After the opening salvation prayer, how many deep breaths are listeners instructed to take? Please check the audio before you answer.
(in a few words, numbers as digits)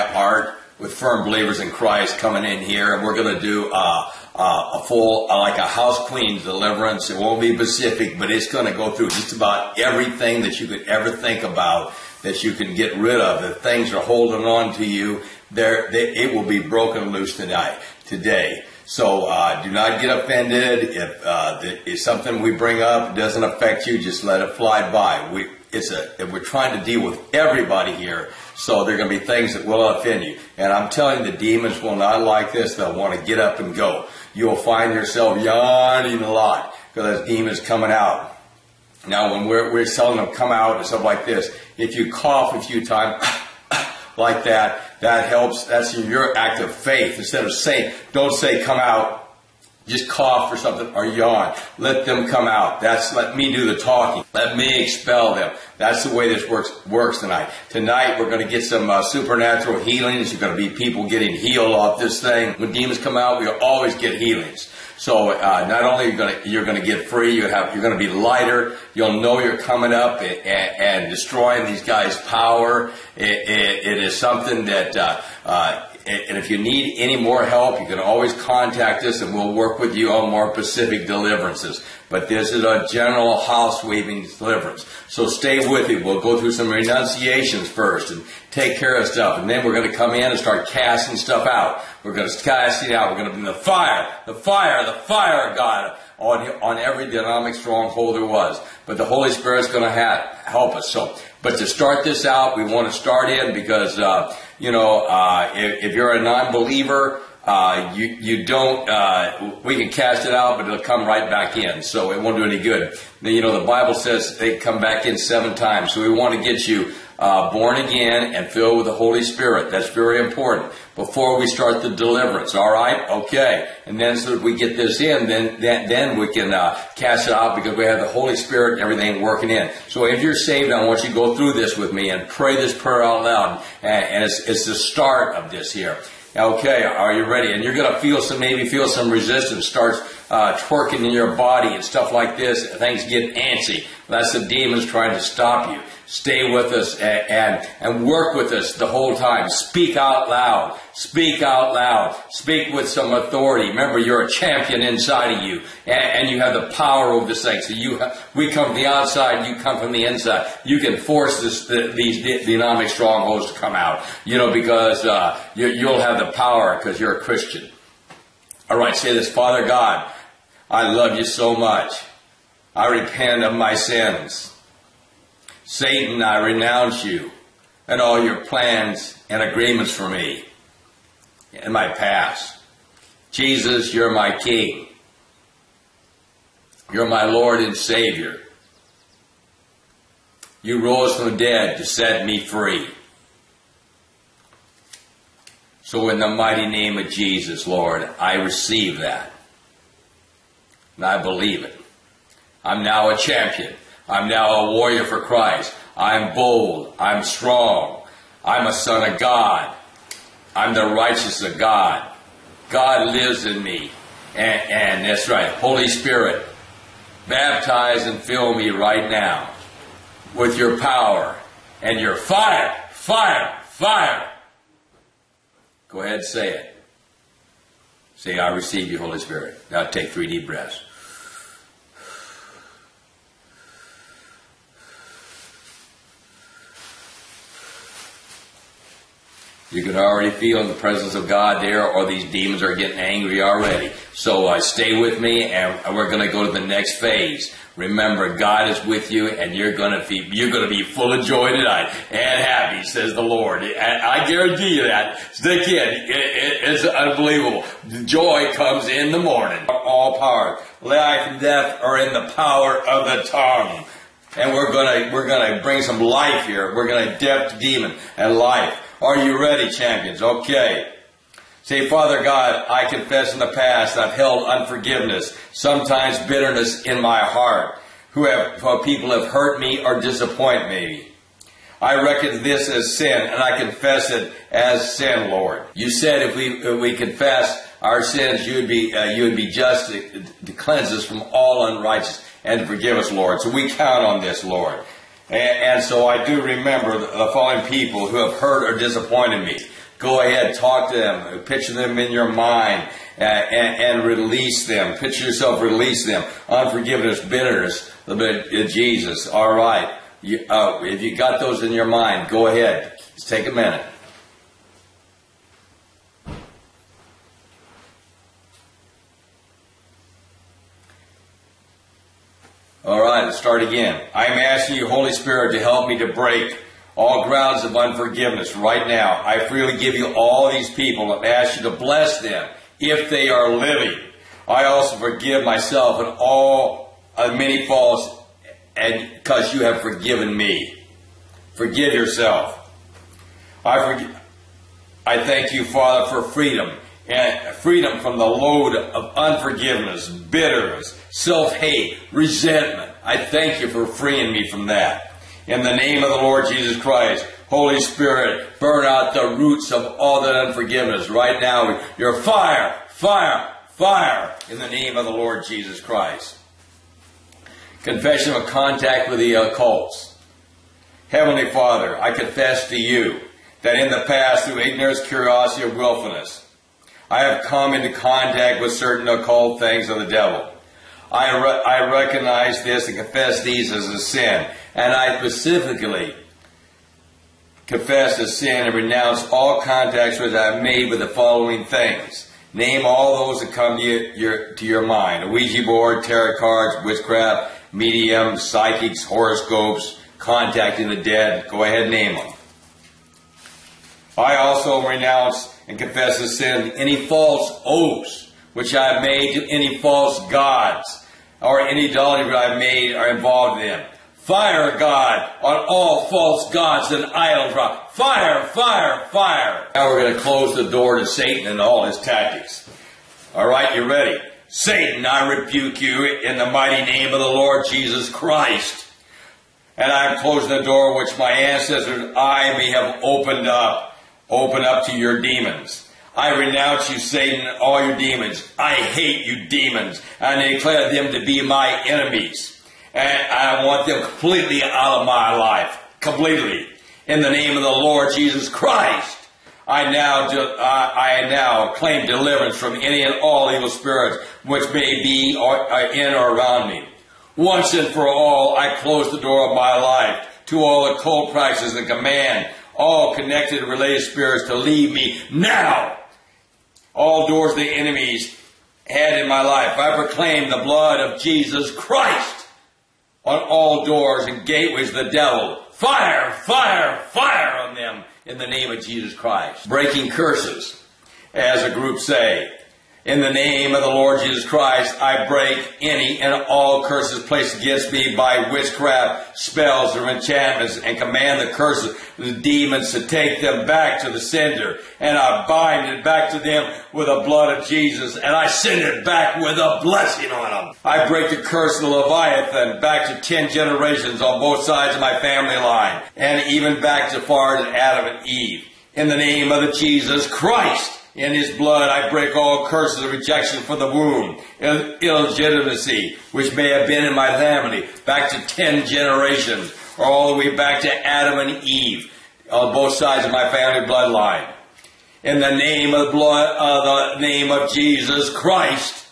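3.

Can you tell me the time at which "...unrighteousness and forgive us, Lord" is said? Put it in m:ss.
4:51.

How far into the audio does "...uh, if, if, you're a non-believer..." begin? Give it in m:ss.
1:45.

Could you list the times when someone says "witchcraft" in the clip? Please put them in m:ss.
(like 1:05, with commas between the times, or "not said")
6:36, 8:08.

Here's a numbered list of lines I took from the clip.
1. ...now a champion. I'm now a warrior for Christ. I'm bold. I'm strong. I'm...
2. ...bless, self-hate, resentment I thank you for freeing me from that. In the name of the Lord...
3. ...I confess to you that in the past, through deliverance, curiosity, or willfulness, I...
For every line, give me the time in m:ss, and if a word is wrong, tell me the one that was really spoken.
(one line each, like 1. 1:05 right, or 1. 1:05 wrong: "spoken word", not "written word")
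1. 3:22 right
2. 5:50 wrong: "bitterness", not "bless"
3. 6:11 wrong: "ignorance", not "deliverance".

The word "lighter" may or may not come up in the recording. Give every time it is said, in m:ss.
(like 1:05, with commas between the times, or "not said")
1:08.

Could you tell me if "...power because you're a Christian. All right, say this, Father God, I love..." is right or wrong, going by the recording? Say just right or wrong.
right.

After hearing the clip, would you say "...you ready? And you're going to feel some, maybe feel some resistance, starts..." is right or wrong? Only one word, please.
right.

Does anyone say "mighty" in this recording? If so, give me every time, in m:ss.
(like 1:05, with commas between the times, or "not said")
3:16, 7:06.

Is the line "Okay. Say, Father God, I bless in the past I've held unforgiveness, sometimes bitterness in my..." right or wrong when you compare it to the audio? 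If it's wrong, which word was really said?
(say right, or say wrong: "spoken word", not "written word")
wrong: "confess", not "bless".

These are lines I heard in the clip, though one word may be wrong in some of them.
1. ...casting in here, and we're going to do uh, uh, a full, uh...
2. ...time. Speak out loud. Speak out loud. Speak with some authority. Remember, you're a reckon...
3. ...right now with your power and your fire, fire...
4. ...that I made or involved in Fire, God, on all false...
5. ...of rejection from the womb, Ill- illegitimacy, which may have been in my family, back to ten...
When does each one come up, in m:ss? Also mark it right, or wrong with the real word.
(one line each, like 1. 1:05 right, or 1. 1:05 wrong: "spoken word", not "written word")
1. 0:02 wrong: "coming", not "casting"
2. 2:29 wrong: "champion", not "reckon"
3. 3:38 right
4. 6:52 right
5. 8:33 right.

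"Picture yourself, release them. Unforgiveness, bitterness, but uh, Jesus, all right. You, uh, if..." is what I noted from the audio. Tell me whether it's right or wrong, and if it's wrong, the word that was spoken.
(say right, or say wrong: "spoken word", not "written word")
right.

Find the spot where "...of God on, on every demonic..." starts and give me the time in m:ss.
1:35.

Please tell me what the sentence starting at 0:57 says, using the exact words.
Tonight we're going to get some uh, supernatural healings.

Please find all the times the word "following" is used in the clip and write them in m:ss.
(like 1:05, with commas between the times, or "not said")
4:57, 6:31.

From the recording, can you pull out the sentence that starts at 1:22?
But this is a general house weaving deliverance.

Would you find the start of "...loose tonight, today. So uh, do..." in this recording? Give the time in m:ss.
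0:17.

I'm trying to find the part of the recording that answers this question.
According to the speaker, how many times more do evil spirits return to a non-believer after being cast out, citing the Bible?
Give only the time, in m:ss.
1:55.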